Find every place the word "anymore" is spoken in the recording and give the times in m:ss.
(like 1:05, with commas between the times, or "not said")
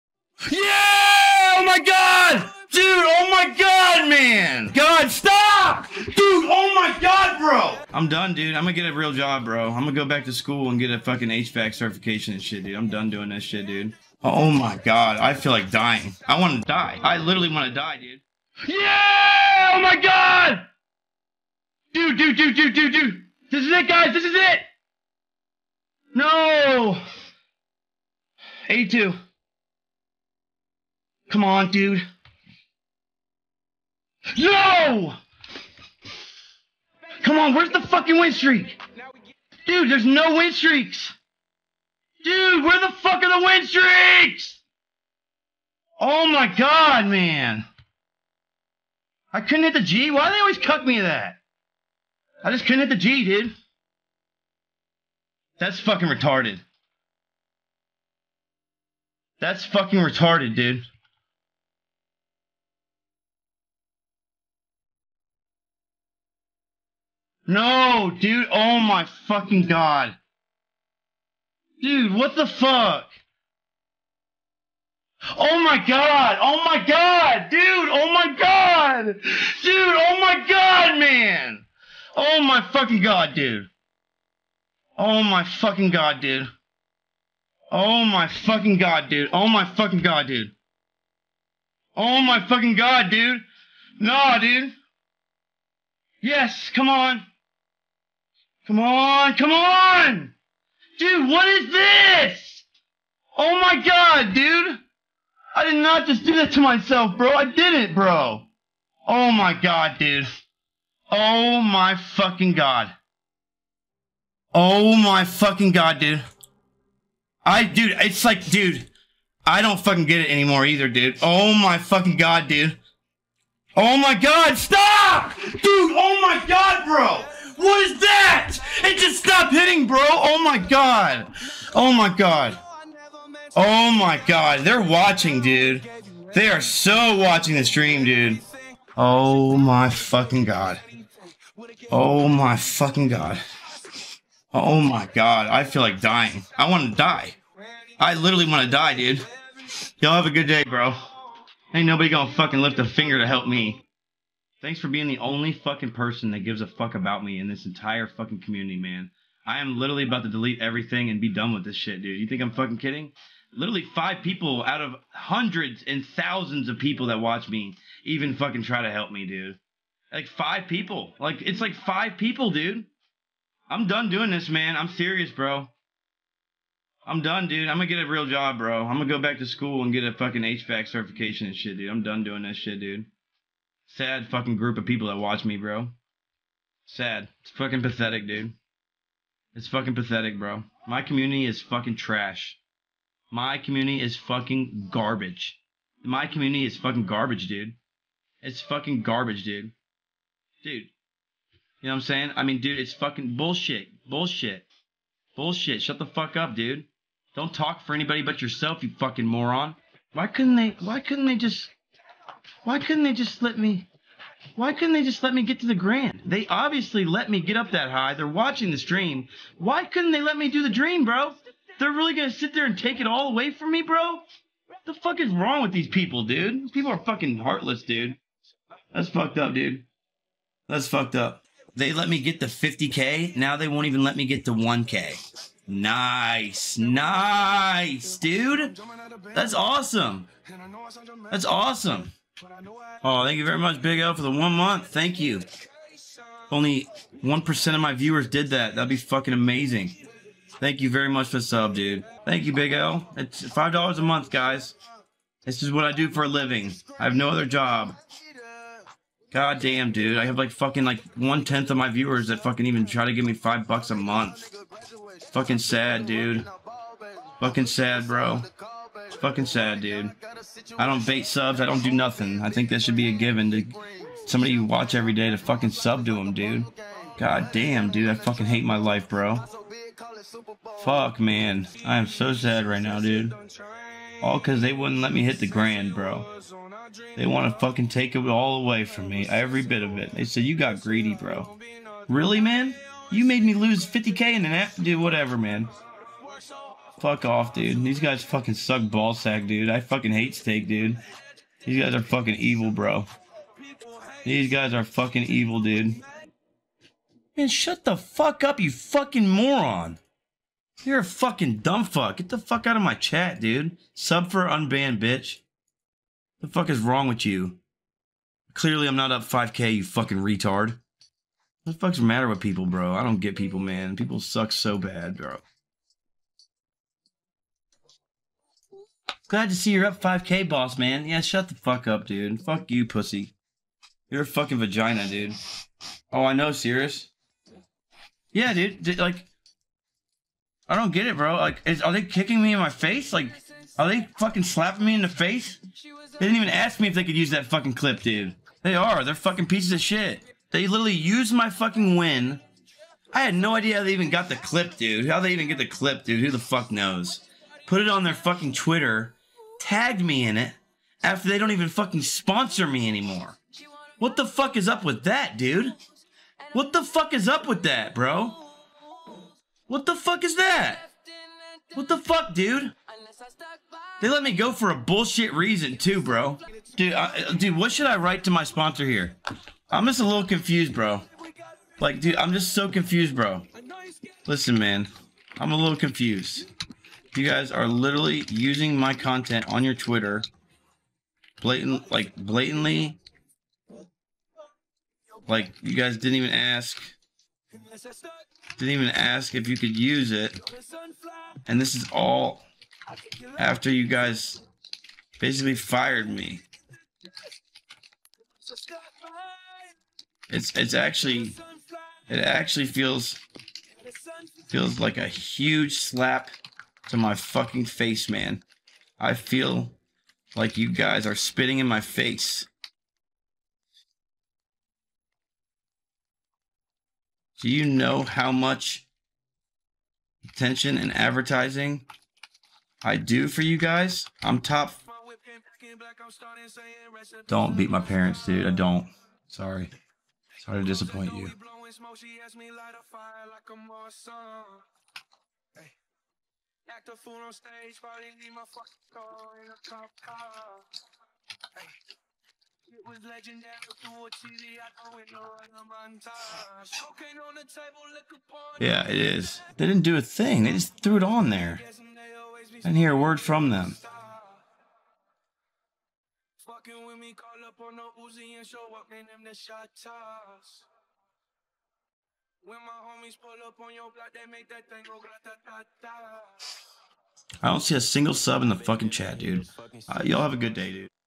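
2:00, 6:02.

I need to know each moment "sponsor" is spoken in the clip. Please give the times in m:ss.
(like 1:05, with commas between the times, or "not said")
6:02, 6:18.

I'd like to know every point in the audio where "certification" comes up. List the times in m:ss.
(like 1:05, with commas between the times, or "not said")
0:11, 3:00.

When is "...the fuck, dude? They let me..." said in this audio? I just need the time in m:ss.
6:11.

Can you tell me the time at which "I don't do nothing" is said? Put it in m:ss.
4:31.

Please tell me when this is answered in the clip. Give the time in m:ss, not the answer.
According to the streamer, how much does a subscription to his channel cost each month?
4:13.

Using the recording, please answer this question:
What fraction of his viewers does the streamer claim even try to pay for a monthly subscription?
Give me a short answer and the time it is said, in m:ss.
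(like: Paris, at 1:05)
one tenth, at 4:21.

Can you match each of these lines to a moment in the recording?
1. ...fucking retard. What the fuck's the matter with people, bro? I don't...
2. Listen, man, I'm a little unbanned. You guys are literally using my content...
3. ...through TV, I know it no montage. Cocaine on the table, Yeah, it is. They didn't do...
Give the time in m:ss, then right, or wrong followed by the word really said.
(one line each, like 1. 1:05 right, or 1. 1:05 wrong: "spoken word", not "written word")
1. 5:19 right
2. 6:24 wrong: "confused", not "unbanned"
3. 7:33 right.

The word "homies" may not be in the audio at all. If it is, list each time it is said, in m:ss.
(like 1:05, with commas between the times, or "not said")
7:52.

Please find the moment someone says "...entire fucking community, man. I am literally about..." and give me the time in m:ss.
2:37.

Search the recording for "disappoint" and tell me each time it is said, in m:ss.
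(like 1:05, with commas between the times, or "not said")
7:20.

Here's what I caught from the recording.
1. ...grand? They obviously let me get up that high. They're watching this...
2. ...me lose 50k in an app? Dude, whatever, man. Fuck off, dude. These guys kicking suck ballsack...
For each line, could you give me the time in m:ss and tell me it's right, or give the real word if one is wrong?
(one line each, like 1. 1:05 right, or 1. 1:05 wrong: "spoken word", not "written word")
1. 3:35 right
2. 4:53 wrong: "fucking", not "kicking".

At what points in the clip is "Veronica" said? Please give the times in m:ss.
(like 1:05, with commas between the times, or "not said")
not said.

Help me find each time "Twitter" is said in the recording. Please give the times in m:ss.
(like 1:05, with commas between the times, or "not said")
5:58, 6:29.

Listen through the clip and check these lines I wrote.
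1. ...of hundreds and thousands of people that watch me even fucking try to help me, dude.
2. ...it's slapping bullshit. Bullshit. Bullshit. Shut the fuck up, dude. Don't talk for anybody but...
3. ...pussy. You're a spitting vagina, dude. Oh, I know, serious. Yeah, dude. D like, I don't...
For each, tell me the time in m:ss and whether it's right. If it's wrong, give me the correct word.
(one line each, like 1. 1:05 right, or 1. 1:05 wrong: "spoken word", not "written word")
1. 2:44 right
2. 3:22 wrong: "fucking", not "slapping"
3. 5:32 wrong: "fucking", not "spitting".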